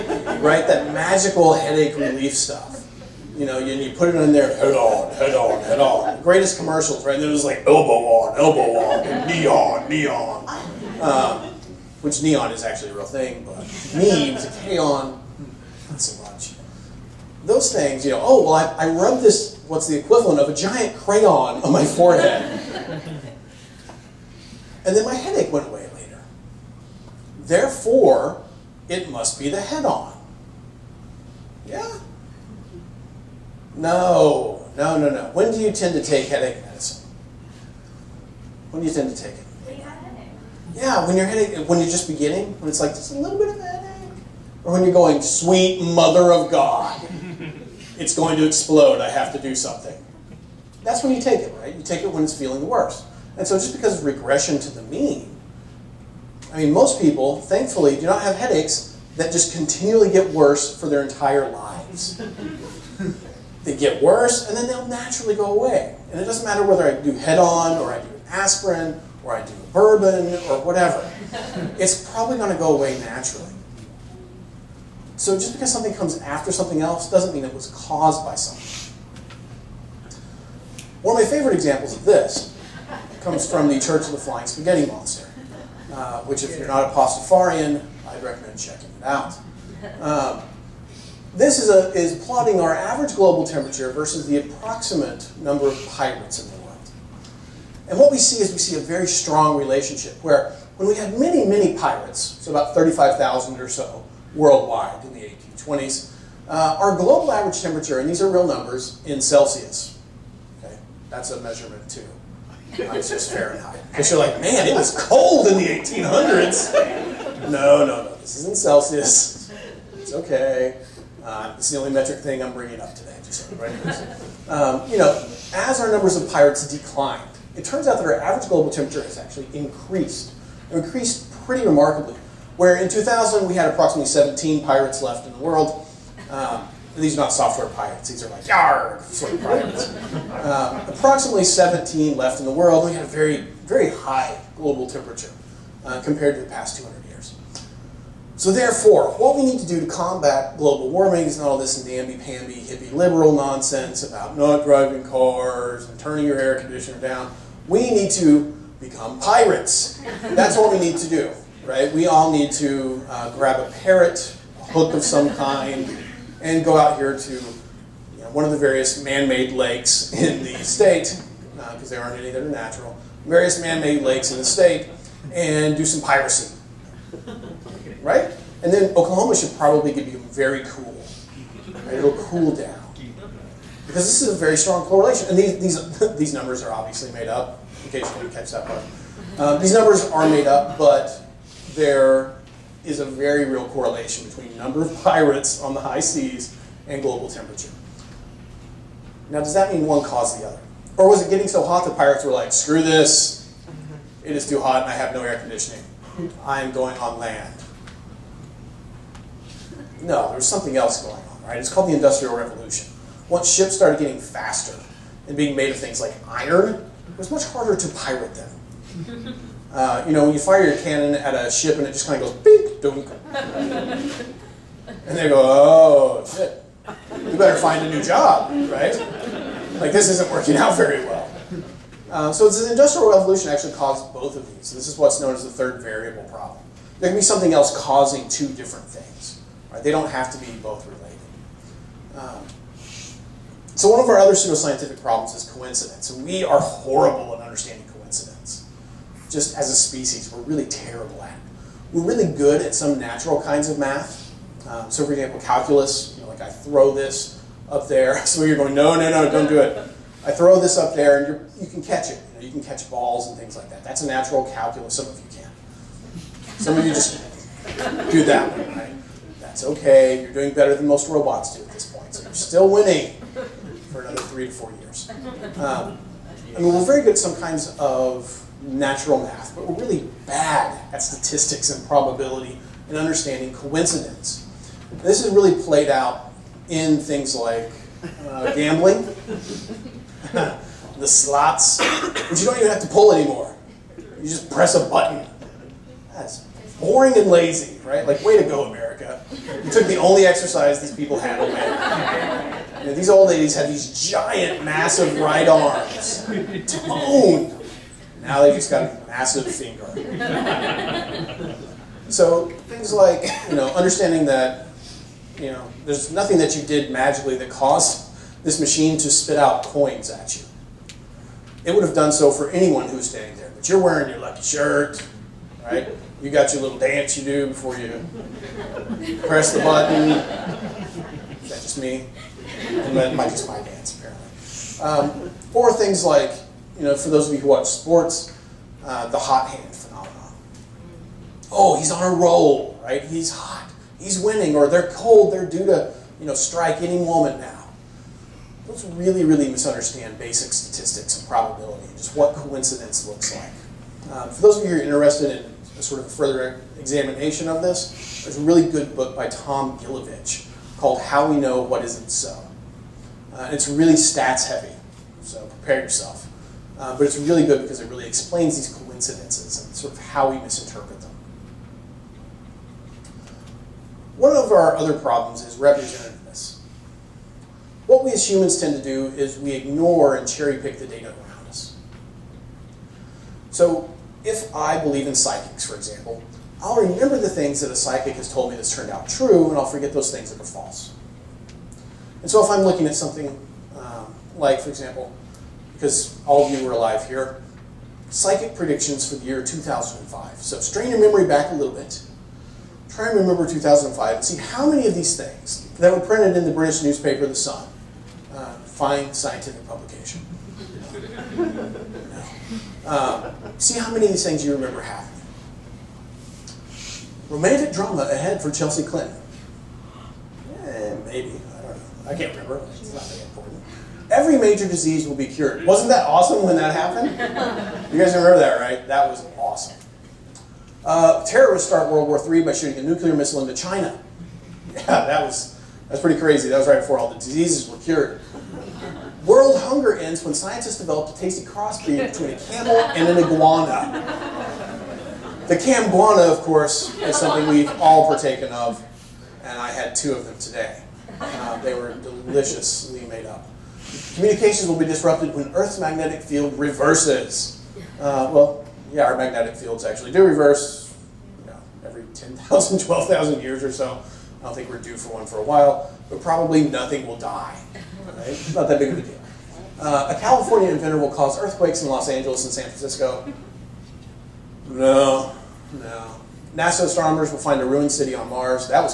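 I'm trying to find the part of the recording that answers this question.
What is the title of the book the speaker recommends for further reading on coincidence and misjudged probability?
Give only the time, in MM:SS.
06:00.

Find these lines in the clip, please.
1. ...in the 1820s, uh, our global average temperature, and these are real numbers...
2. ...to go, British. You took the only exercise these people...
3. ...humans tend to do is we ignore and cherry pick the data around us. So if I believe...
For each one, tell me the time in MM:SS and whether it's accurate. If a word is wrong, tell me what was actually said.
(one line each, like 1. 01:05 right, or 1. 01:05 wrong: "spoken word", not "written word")
1. 01:45 right
2. 04:58 wrong: "America", not "British"
3. 06:18 right.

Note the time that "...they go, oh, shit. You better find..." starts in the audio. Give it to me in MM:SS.
03:45.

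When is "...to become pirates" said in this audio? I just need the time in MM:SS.
02:38.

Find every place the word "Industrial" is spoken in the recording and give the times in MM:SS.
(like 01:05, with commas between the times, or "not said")
03:31, 03:52.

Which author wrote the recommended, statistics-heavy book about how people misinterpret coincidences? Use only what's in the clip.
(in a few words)
Tom Gilovich.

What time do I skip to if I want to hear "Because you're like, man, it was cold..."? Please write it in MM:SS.
01:53.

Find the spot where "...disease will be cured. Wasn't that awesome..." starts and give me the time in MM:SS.
07:04.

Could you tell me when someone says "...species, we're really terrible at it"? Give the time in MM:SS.
04:09.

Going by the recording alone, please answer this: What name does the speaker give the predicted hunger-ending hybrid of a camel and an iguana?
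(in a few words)
camguana.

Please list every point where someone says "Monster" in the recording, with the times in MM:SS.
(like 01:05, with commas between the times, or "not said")
01:24.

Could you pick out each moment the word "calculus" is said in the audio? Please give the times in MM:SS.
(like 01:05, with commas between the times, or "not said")
04:15, 04:24.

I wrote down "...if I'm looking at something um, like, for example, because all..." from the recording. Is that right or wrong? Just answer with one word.
right.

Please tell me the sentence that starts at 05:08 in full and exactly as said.
Now they've just got a massive finger.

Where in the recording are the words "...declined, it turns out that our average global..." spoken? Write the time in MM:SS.
02:06.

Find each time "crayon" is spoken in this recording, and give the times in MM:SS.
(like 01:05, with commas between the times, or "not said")
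00:14, 00:20.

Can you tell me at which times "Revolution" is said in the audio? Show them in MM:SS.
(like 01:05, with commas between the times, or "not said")
03:32, 03:53.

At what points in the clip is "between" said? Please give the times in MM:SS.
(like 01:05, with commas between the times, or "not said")
03:14, 07:22.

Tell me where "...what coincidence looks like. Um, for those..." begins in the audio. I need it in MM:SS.
05:52.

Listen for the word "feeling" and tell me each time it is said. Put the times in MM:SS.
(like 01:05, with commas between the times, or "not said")
00:52.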